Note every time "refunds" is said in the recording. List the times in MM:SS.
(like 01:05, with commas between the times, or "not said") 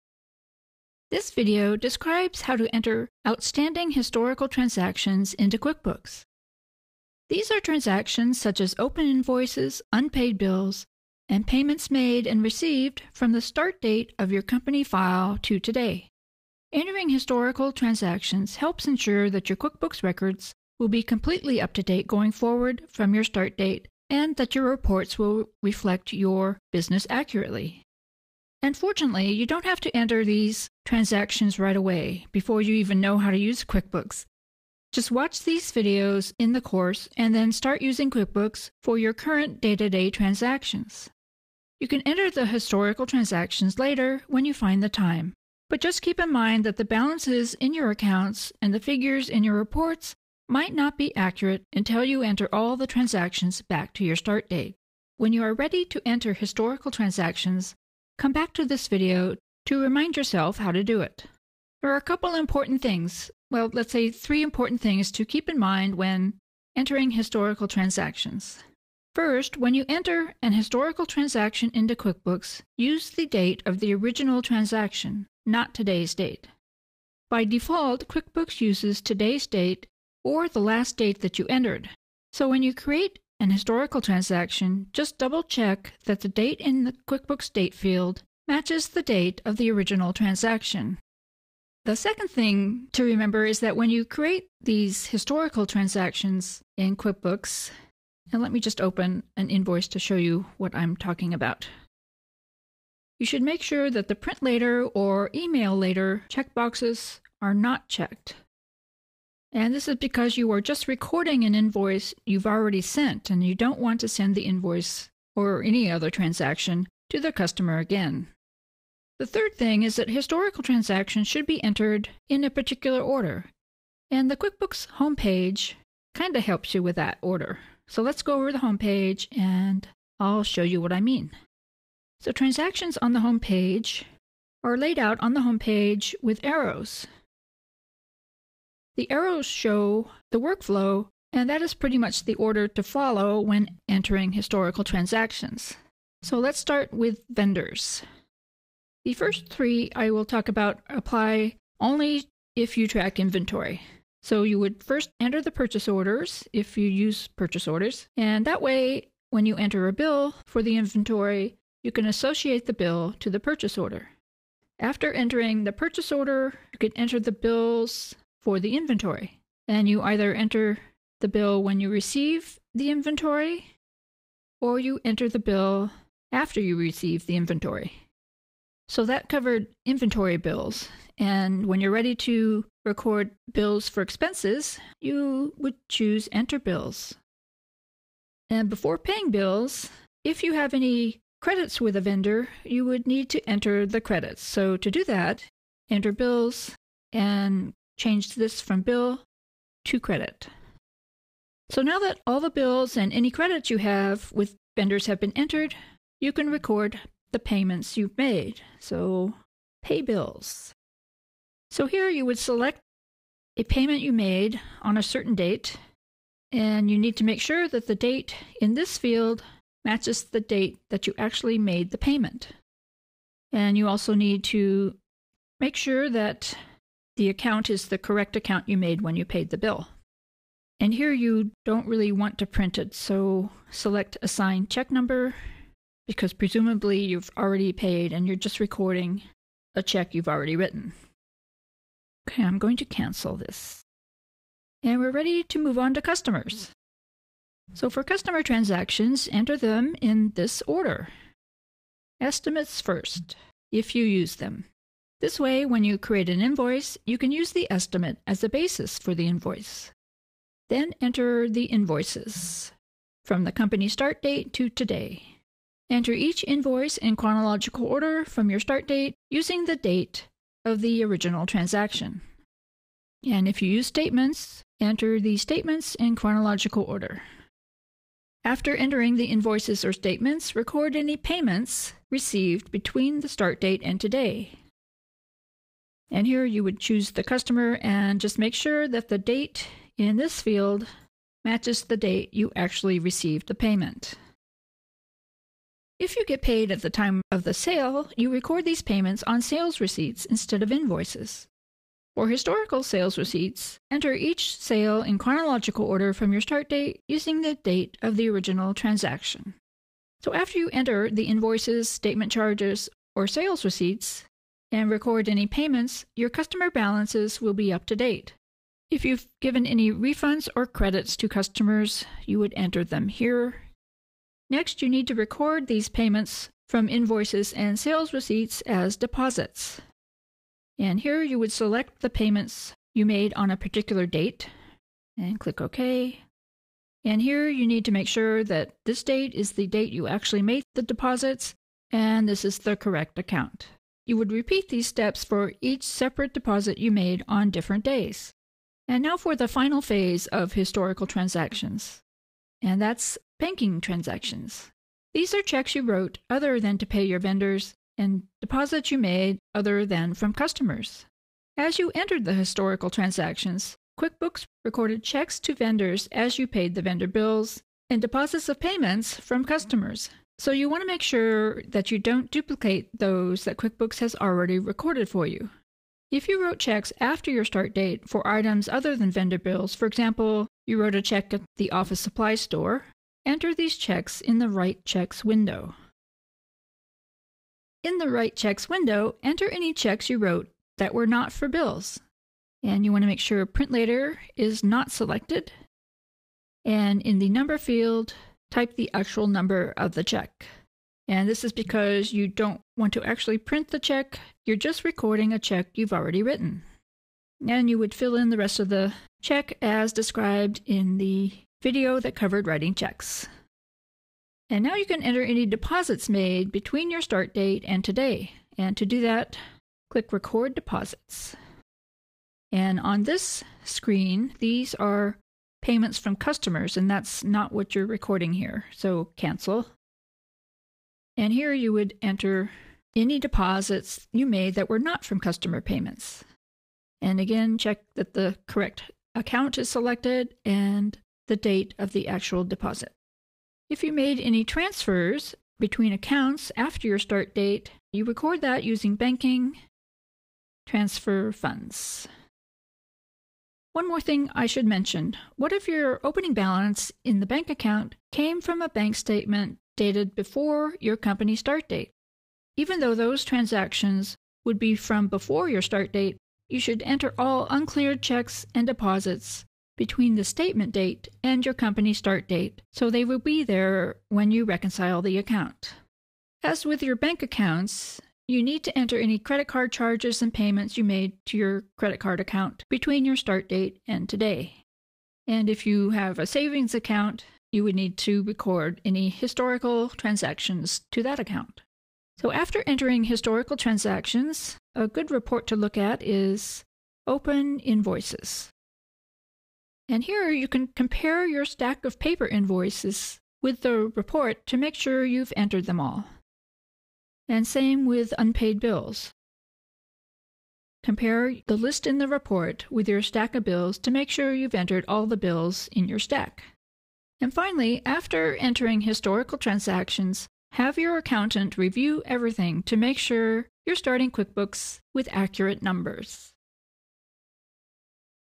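05:19.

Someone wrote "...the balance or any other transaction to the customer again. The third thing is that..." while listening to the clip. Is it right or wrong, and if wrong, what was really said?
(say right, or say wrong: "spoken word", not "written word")
wrong: "invoice", not "balance".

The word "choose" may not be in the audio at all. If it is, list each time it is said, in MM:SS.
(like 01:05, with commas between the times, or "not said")
03:05, 04:46.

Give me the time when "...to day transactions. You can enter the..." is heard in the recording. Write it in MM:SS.
00:39.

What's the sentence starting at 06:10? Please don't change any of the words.
So you want to make sure that you don't duplicate those that QuickBooks has already recorded for you.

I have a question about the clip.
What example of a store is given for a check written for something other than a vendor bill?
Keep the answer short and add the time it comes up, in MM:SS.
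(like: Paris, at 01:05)
Office supply store, at 06:21.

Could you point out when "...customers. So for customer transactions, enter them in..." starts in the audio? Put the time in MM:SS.
04:06.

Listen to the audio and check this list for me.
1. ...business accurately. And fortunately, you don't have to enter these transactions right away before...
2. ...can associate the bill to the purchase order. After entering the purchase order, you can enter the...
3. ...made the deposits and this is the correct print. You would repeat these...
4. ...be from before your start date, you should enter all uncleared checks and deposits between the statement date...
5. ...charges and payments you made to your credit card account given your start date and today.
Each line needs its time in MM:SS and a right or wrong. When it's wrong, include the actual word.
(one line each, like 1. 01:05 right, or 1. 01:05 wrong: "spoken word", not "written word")
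1. 00:26 right
2. 02:41 right
3. 05:40 wrong: "account", not "print"
4. 07:44 right
5. 07:59 wrong: "between", not "given".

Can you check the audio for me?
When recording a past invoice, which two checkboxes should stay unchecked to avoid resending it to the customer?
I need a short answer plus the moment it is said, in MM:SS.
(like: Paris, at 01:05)
print later or email later, at 01:44.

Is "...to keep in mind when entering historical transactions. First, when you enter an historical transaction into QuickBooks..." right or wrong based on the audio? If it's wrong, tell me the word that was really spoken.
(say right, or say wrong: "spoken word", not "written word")
right.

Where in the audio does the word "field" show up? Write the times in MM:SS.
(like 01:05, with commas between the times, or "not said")
01:27, 03:38, 04:50, 06:37.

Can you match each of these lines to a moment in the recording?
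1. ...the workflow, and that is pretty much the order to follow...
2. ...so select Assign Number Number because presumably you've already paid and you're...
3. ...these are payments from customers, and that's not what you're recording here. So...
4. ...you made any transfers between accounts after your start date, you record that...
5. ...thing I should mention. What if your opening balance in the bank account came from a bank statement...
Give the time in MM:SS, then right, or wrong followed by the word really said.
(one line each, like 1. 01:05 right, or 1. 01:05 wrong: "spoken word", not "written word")
1. 02:20 right
2. 03:52 wrong: "Check", not "Number"
3. 07:04 right
4. 07:23 right
5. 07:34 right.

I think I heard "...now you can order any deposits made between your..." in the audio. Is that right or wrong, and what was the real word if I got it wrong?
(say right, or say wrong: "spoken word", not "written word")
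wrong: "enter", not "order".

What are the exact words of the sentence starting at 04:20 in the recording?
Then enter the invoices from the company start date to today.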